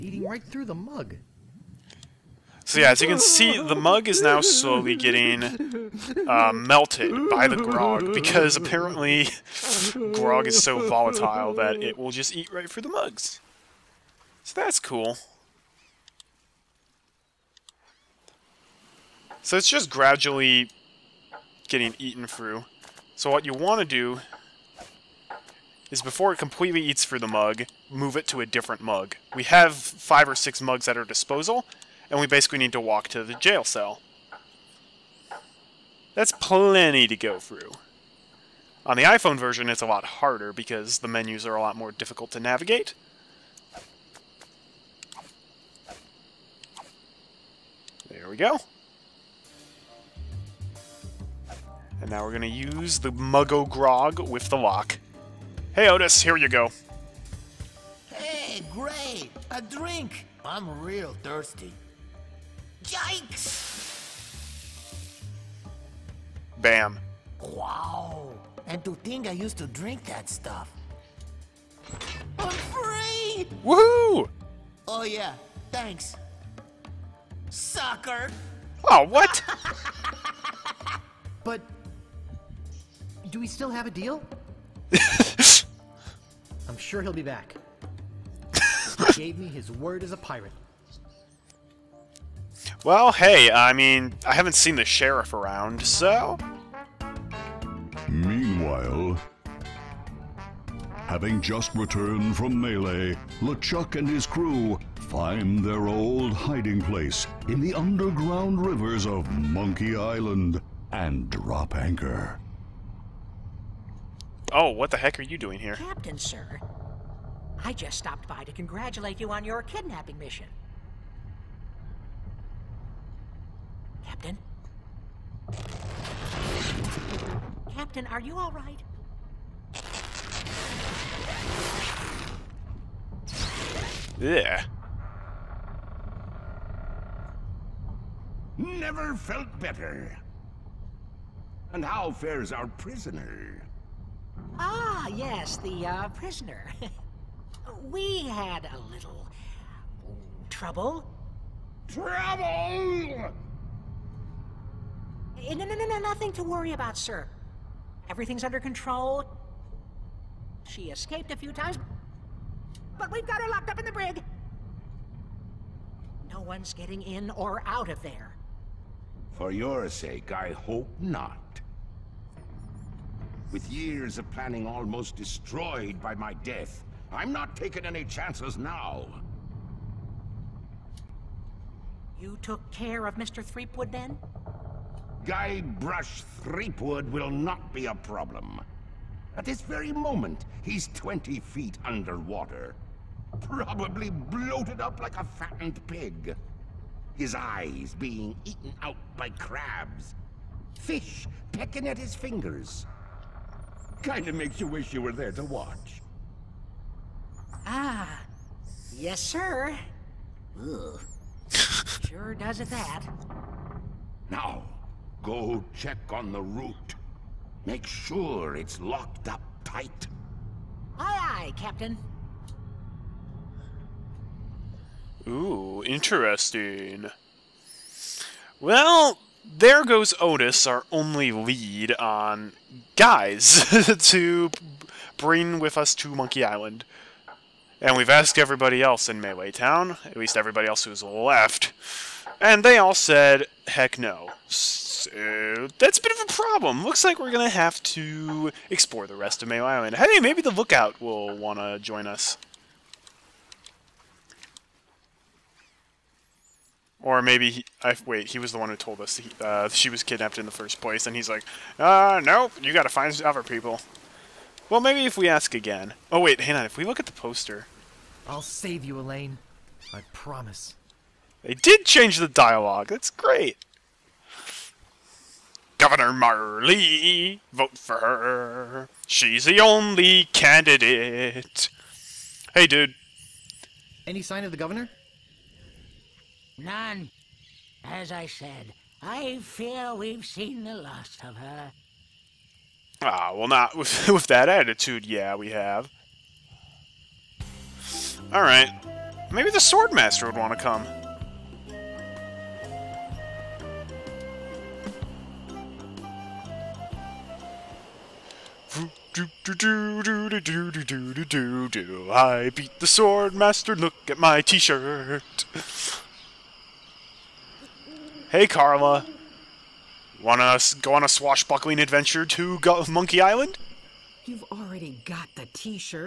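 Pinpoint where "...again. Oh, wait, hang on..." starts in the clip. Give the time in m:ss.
4:25.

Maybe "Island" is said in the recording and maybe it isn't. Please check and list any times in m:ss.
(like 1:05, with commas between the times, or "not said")
1:49, 3:56, 4:09, 5:23.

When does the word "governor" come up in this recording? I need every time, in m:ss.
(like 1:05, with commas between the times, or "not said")
4:35, 4:44.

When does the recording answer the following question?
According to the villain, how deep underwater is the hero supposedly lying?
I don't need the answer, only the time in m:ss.
3:10.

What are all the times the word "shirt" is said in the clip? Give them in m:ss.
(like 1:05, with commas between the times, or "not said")
5:14, 5:25.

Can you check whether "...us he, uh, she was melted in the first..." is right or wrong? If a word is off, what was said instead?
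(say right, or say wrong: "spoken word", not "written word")
wrong: "kidnapped", not "melted".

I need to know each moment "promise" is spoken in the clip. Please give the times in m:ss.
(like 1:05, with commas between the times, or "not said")
4:30.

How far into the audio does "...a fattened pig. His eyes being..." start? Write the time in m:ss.
3:15.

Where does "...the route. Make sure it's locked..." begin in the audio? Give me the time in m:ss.
3:36.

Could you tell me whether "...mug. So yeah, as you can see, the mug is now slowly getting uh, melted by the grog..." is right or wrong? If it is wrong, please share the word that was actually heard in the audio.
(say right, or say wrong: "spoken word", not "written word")
right.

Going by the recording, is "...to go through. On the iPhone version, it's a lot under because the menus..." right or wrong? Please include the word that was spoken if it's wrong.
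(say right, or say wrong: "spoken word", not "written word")
wrong: "harder", not "under".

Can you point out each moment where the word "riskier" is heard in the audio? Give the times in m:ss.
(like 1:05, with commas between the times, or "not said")
not said.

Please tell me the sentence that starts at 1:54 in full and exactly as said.
Oh, what the heck are you doing here?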